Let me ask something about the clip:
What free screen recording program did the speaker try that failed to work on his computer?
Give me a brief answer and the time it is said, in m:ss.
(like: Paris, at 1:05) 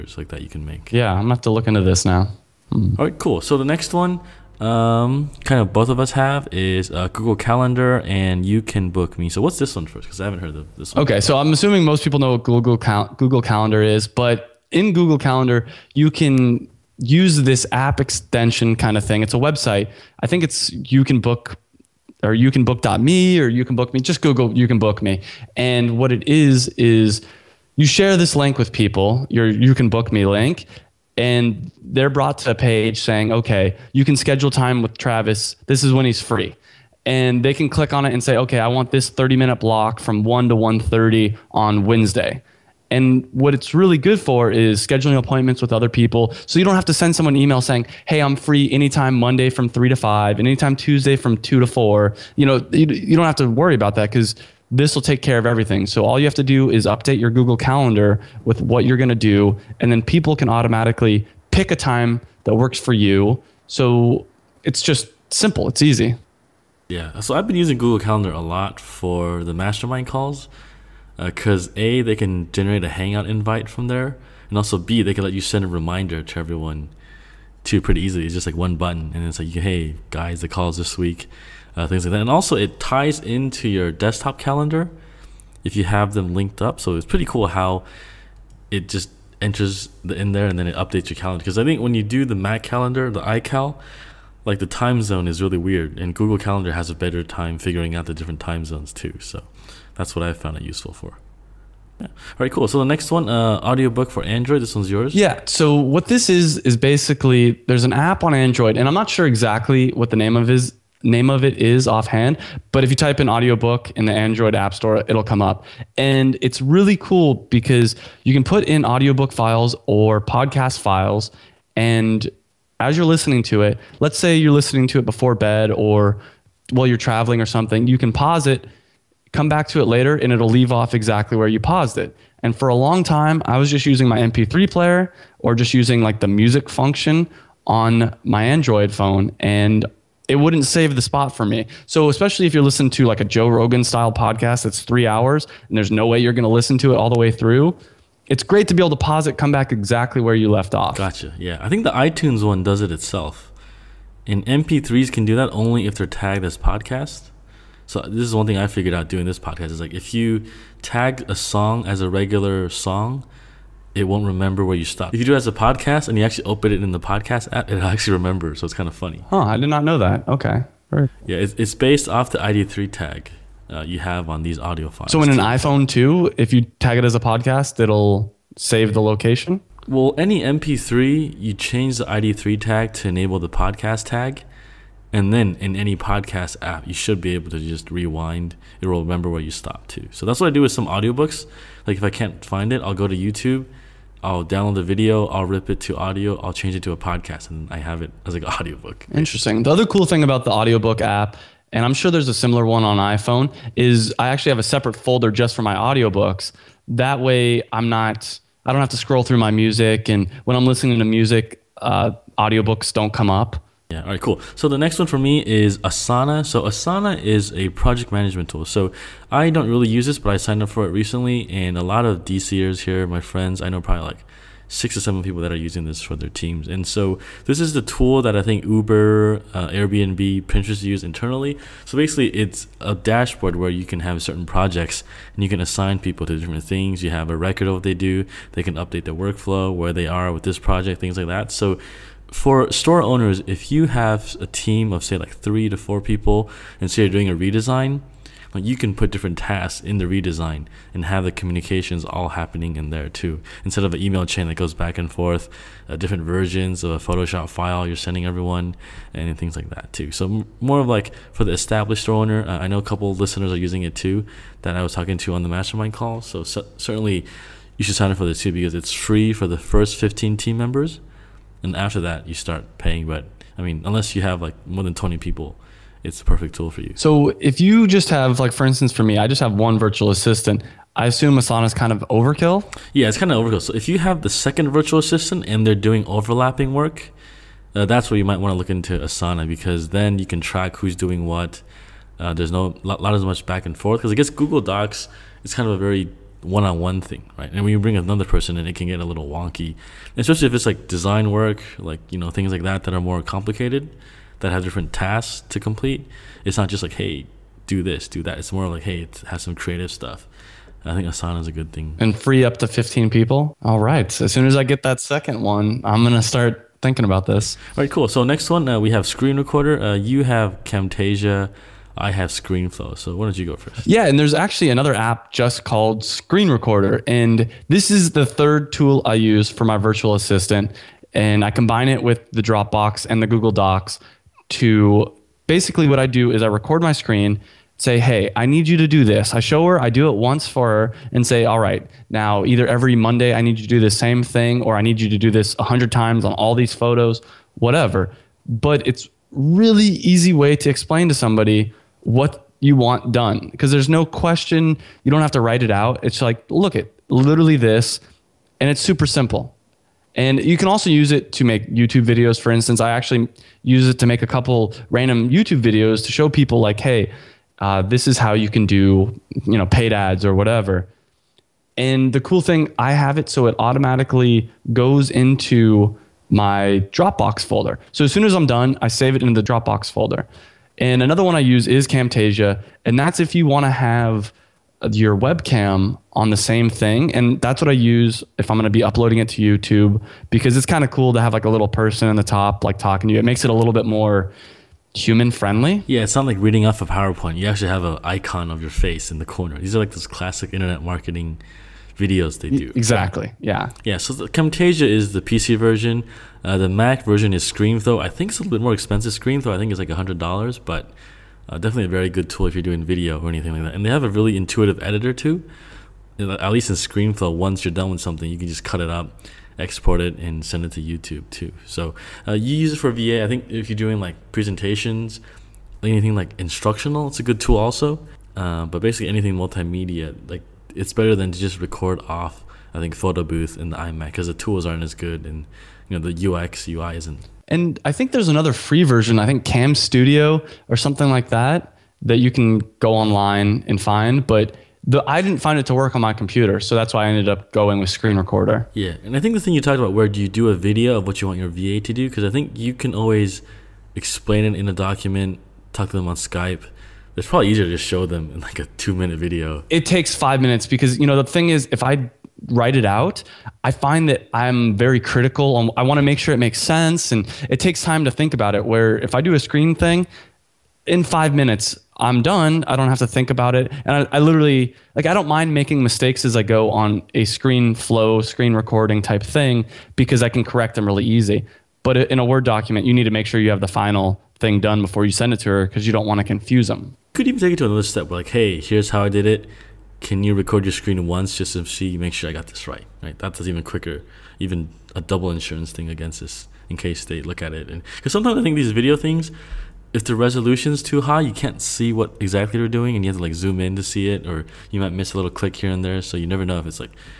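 Cam Studio, at 7:19.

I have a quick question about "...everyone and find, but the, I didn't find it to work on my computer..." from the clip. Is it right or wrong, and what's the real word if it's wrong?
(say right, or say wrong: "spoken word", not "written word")
wrong: "online", not "everyone".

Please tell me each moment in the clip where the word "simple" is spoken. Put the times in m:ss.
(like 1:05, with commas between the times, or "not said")
1:05, 5:59.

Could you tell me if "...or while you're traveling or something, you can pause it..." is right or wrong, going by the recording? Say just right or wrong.
right.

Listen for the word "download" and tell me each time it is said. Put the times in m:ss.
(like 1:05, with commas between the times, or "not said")
3:14.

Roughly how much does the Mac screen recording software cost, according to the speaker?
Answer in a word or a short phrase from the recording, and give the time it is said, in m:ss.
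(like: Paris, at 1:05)
$100, at 6:49.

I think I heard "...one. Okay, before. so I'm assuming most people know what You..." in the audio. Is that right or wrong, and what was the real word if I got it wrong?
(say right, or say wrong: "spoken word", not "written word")
wrong: "Google", not "You".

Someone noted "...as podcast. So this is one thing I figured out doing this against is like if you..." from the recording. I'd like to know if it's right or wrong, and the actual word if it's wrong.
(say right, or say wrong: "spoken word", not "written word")
wrong: "podcast", not "against".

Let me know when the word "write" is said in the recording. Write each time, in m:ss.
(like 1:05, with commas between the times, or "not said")
5:55, 7:42.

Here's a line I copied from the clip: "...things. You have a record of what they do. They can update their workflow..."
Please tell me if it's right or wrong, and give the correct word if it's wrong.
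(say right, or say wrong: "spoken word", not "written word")
right.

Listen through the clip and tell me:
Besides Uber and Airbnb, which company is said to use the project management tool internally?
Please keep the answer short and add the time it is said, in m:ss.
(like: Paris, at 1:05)
Pinterest, at 3:50.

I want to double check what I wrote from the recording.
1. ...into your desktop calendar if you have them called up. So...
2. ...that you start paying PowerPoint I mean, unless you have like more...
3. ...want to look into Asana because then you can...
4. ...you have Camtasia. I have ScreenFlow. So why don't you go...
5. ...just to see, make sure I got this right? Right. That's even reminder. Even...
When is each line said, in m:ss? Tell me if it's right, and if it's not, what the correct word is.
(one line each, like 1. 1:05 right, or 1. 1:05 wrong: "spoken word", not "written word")
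1. 1:23 wrong: "linked", not "called"
2. 4:31 wrong: "But", not "PowerPoint"
3. 4:48 right
4. 5:19 right
5. 8:11 wrong: "quicker", not "reminder".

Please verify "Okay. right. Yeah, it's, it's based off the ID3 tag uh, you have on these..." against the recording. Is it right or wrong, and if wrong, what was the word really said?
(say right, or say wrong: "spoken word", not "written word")
right.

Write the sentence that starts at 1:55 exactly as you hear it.
And it's really cool because you can put in audiobook files or podcast files.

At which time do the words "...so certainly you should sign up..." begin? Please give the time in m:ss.
4:26.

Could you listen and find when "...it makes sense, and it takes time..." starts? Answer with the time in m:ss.
7:46.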